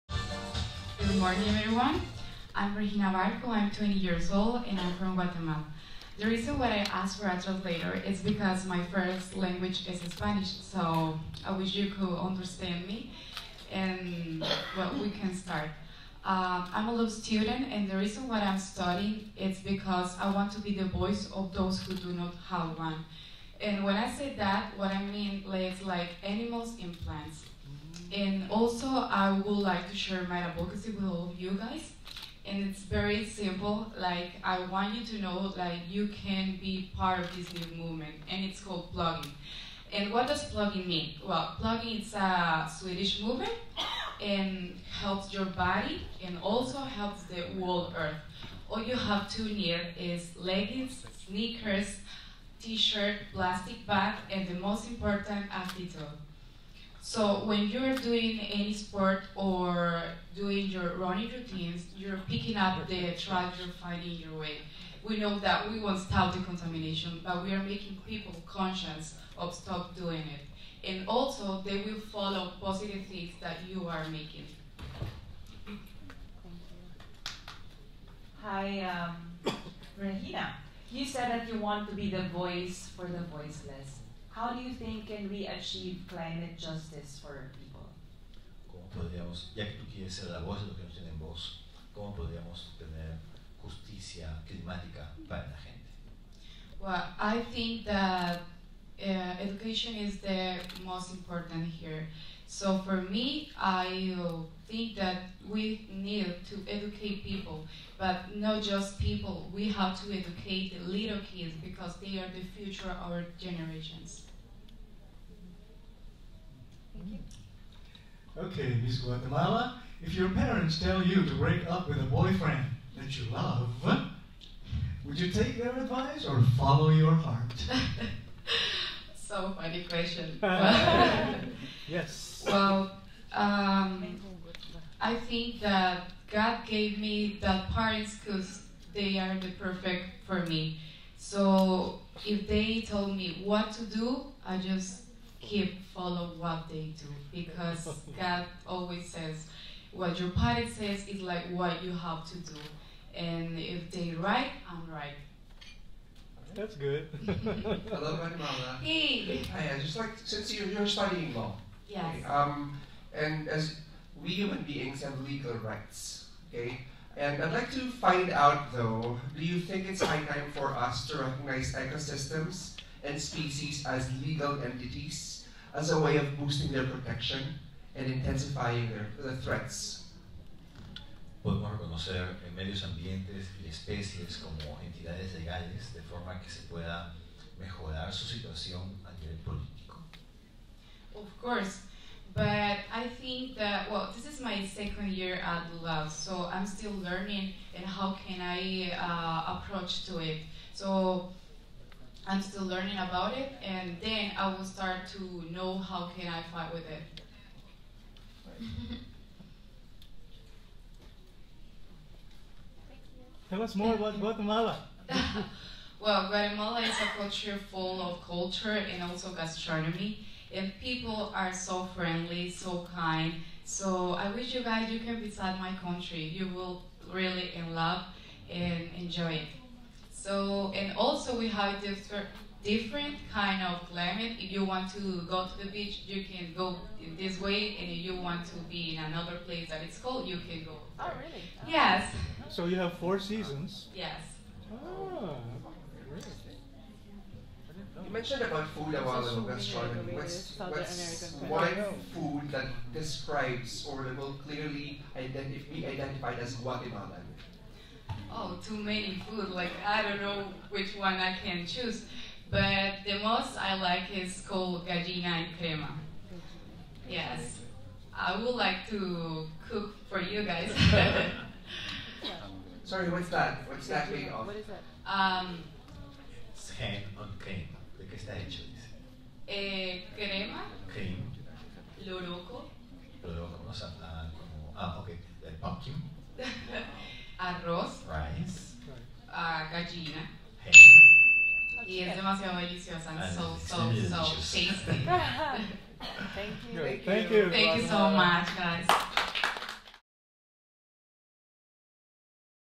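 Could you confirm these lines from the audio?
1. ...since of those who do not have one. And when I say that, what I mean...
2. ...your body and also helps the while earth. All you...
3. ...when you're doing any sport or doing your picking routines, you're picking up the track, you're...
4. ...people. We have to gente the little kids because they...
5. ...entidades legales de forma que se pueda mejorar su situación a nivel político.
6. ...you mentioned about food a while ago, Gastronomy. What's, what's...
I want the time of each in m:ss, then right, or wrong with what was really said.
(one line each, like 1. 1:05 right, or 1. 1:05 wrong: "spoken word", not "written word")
1. 0:20 wrong: "voice", not "since"
2. 0:45 wrong: "whole", not "while"
3. 0:57 wrong: "running", not "picking"
4. 1:48 wrong: "educate", not "gente"
5. 3:04 right
6. 4:08 right.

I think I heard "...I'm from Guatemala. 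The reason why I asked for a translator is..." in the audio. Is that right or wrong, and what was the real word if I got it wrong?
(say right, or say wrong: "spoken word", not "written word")
right.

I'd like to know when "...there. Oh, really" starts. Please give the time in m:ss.
4:01.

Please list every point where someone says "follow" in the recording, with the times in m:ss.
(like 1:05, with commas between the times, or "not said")
1:12, 2:06, 2:25.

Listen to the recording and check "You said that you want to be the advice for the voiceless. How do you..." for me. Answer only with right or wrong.
wrong.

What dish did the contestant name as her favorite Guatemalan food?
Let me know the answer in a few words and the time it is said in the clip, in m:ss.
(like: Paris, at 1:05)
Gallina in crema, at 4:24.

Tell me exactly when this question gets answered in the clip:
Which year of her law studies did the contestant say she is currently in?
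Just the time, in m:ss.
3:14.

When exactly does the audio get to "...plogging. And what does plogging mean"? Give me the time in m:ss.
0:38.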